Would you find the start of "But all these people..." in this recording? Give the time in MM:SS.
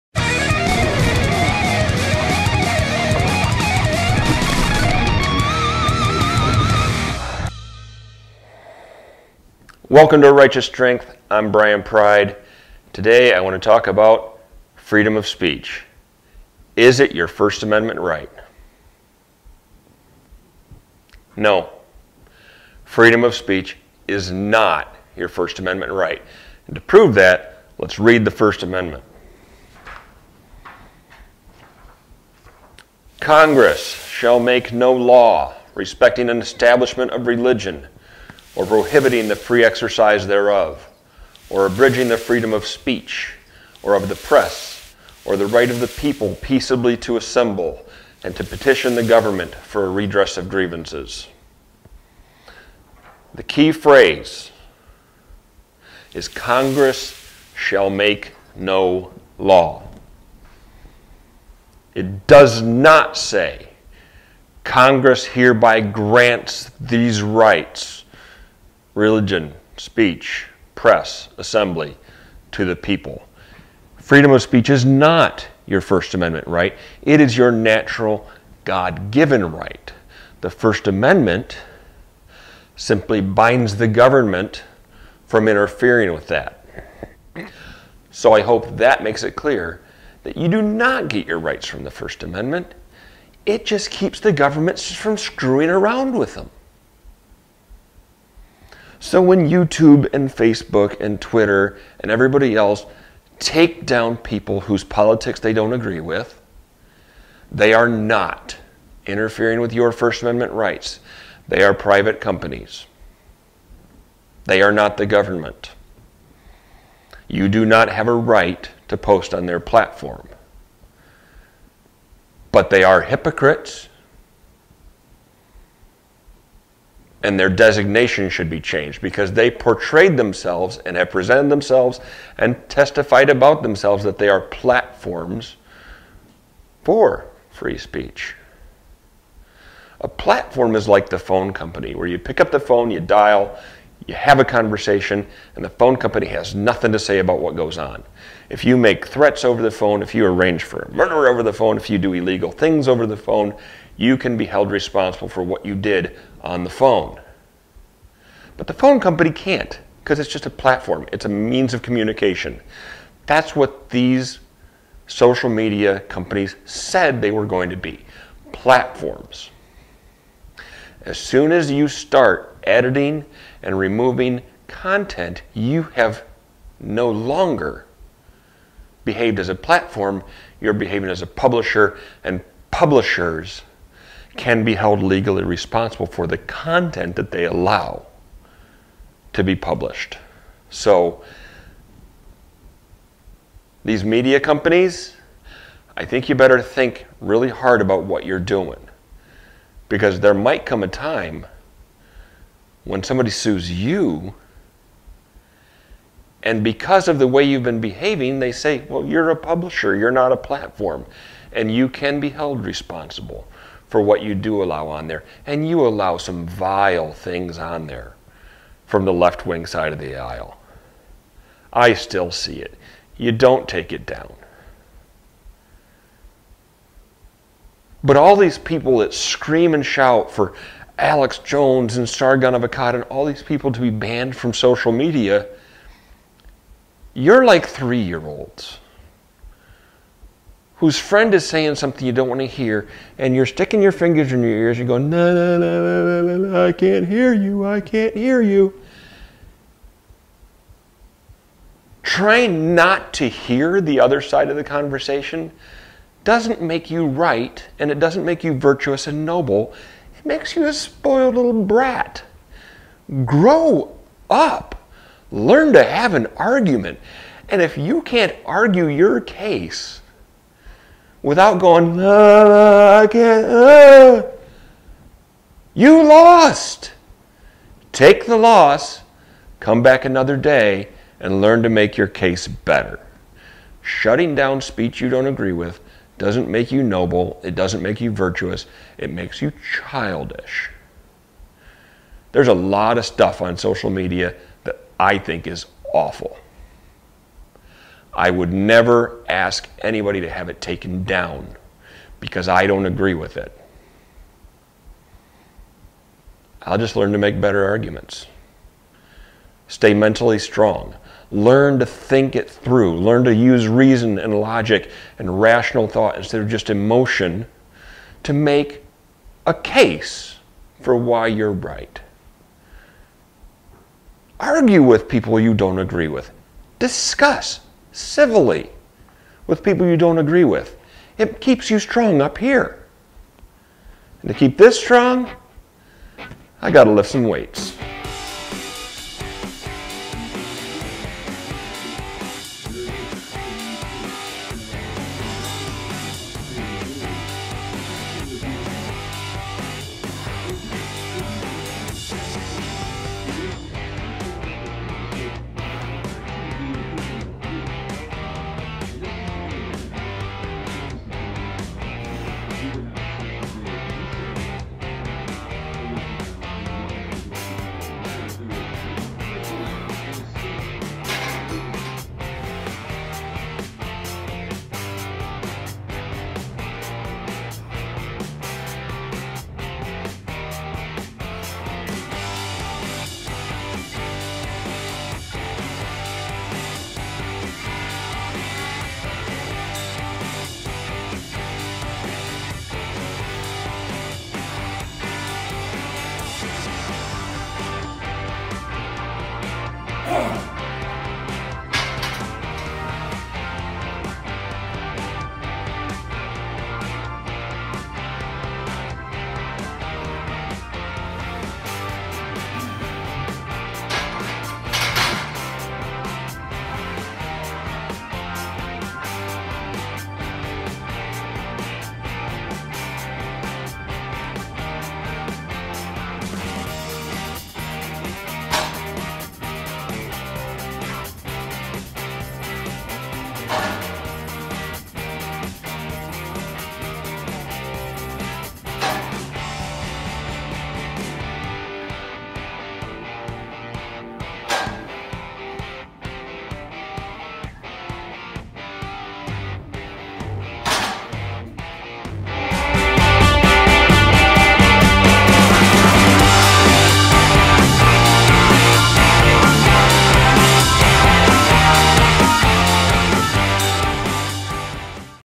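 03:48.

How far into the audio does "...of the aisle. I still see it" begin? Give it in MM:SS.
03:39.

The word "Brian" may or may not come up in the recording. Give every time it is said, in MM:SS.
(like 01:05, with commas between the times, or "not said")
00:11.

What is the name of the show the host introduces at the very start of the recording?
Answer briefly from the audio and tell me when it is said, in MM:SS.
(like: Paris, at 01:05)
Righteous Strength, at 00:10.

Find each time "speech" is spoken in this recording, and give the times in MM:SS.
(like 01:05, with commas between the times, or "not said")
00:15, 00:23, 00:42, 01:09, 01:14, 02:17, 04:44.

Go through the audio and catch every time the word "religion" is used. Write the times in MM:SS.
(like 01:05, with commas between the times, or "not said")
00:37, 01:08.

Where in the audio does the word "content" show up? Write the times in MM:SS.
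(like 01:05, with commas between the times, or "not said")
02:54, 03:06.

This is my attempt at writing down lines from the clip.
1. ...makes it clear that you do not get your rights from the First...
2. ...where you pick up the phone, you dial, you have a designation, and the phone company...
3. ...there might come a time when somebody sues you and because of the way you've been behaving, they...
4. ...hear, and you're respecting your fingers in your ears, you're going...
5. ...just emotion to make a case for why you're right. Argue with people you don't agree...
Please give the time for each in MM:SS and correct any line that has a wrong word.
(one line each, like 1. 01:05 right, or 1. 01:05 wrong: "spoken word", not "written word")
1. 01:29 right
2. 02:21 wrong: "conversation", not "designation"
3. 03:20 right
4. 04:02 wrong: "sticking", not "respecting"
5. 05:16 right.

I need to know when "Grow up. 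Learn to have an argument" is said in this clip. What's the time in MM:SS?
04:23.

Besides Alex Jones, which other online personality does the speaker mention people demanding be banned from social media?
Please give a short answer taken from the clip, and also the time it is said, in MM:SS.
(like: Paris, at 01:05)
Sargon of Akkad, at 03:52.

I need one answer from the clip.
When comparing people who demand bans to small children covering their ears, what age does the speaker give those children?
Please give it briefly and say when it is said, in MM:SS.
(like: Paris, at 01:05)
3, at 03:57.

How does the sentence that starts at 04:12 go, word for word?
Try not to hear the other side of the conversation doesn't make you right, and it doesn't make you virtuous and noble.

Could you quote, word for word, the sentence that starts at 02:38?
But the phone company can't because it's just a platform, it's a means of communication.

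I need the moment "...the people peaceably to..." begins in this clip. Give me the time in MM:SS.
00:45.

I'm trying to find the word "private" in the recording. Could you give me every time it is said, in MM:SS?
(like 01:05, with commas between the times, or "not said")
01:51.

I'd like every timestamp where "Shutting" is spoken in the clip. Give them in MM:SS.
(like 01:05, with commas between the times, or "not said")
04:43.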